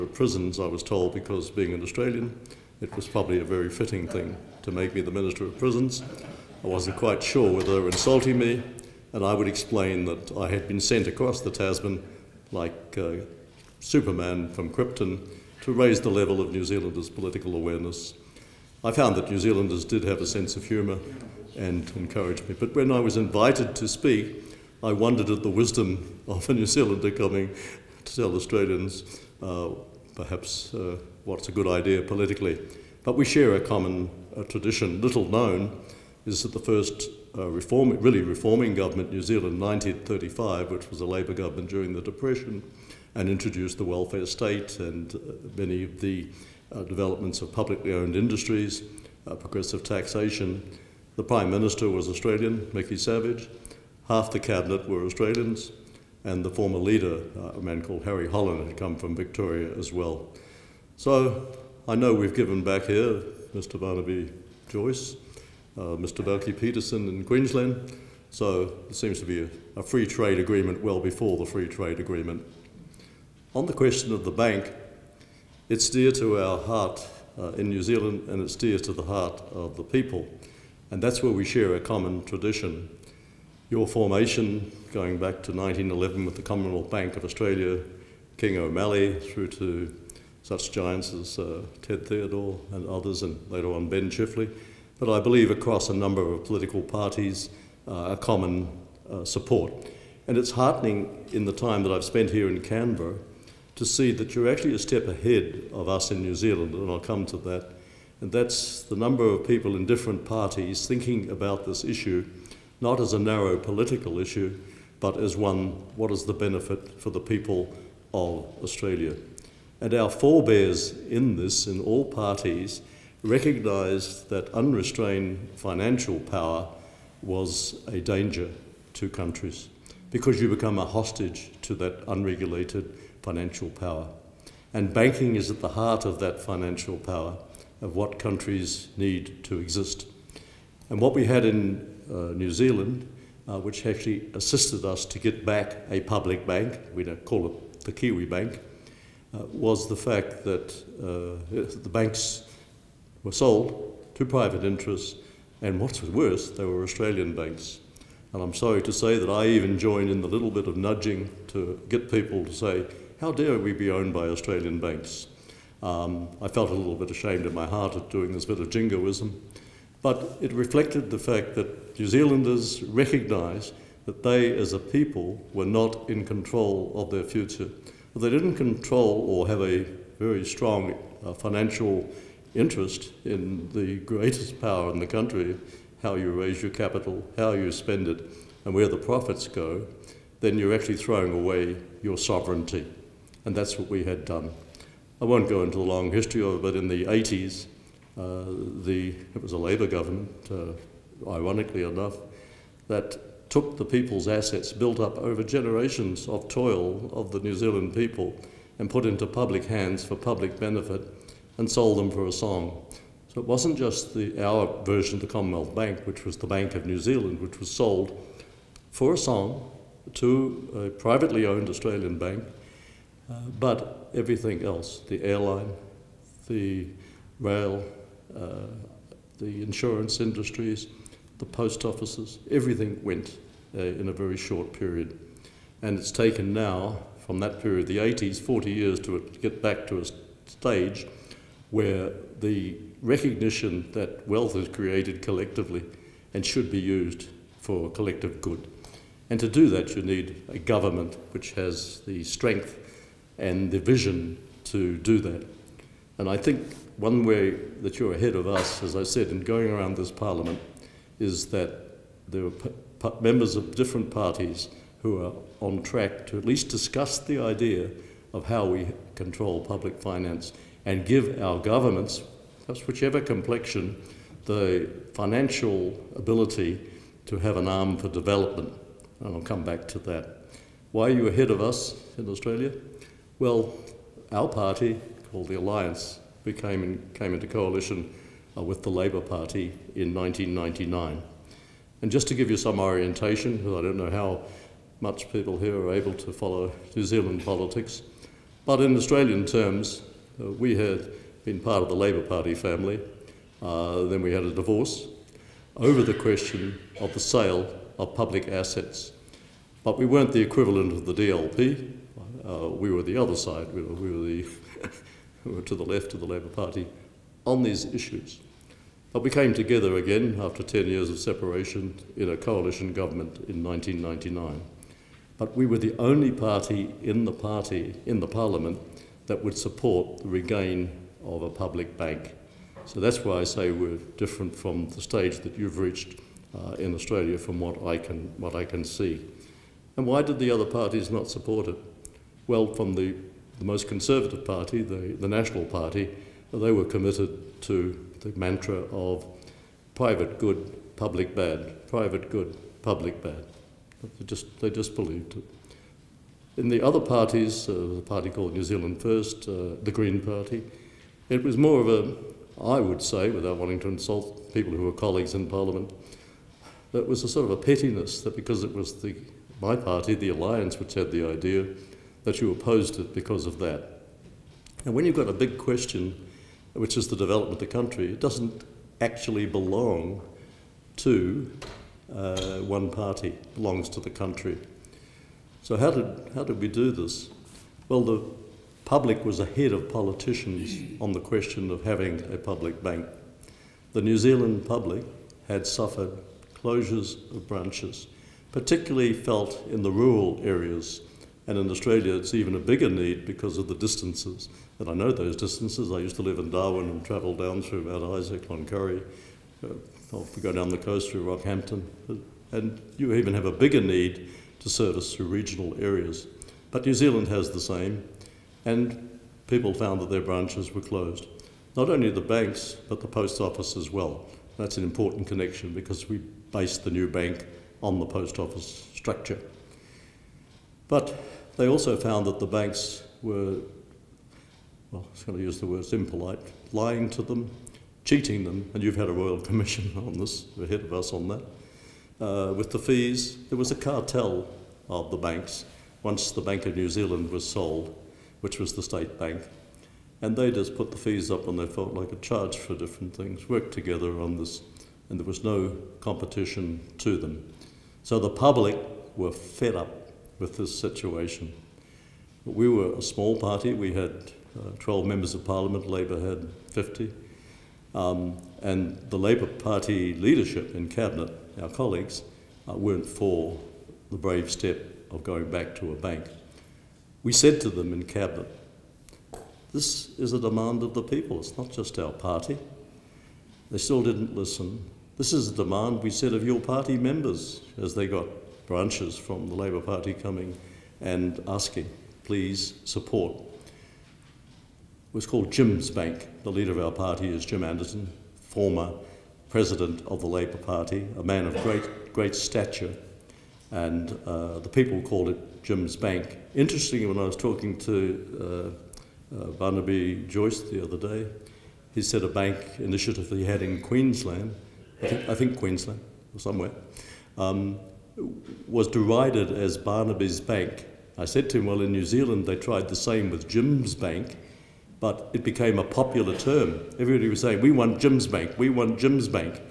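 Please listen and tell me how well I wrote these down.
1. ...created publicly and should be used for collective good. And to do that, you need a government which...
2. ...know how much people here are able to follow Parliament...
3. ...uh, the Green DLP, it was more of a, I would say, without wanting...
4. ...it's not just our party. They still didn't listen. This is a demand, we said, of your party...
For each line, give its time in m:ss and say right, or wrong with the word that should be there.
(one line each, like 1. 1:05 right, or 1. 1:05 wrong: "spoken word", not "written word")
1. 4:04 wrong: "collectively", not "publicly"
2. 4:53 wrong: "New", not "Parliament"
3. 5:59 wrong: "Party", not "DLP"
4. 8:01 right.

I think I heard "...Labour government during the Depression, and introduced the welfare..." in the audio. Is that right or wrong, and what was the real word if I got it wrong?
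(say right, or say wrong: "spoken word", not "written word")
right.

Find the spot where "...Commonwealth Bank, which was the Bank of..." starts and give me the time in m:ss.
3:35.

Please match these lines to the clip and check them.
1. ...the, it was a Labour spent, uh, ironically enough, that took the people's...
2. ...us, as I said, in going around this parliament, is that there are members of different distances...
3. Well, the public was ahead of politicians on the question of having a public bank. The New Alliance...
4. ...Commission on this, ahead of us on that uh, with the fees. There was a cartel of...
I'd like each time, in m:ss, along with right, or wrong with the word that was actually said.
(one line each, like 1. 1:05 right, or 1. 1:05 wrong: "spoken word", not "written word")
1. 3:18 wrong: "government", not "spent"
2. 4:18 wrong: "parties", not "distances"
3. 6:27 wrong: "Zealand", not "Alliance"
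4. 7:19 right.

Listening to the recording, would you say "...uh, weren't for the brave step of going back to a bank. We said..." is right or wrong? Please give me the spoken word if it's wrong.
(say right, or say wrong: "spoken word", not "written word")
right.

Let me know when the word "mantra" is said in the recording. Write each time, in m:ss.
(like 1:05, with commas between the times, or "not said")
5:48.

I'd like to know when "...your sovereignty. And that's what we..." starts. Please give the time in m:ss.
3:12.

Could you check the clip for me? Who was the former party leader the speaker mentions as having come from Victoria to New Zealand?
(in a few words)
Harry Holland.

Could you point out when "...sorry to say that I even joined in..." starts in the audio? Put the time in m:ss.
2:38.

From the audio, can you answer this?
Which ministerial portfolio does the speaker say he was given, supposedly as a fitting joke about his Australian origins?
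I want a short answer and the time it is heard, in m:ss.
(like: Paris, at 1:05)
Minister of Prisons, at 0:05.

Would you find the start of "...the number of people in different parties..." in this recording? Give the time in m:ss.
1:48.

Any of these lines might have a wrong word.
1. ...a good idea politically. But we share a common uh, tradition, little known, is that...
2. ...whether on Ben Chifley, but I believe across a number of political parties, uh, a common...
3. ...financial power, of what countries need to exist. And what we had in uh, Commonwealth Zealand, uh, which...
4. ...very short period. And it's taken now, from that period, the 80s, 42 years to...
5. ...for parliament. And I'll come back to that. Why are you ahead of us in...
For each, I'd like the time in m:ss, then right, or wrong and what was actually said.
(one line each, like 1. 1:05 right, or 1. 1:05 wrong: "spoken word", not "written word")
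1. 0:31 right
2. 1:33 wrong: "later", not "whether"
3. 2:16 wrong: "New", not "Commonwealth"
4. 3:54 wrong: "40", not "42"
5. 4:37 wrong: "development", not "parliament".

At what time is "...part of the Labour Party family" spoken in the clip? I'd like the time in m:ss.
5:01.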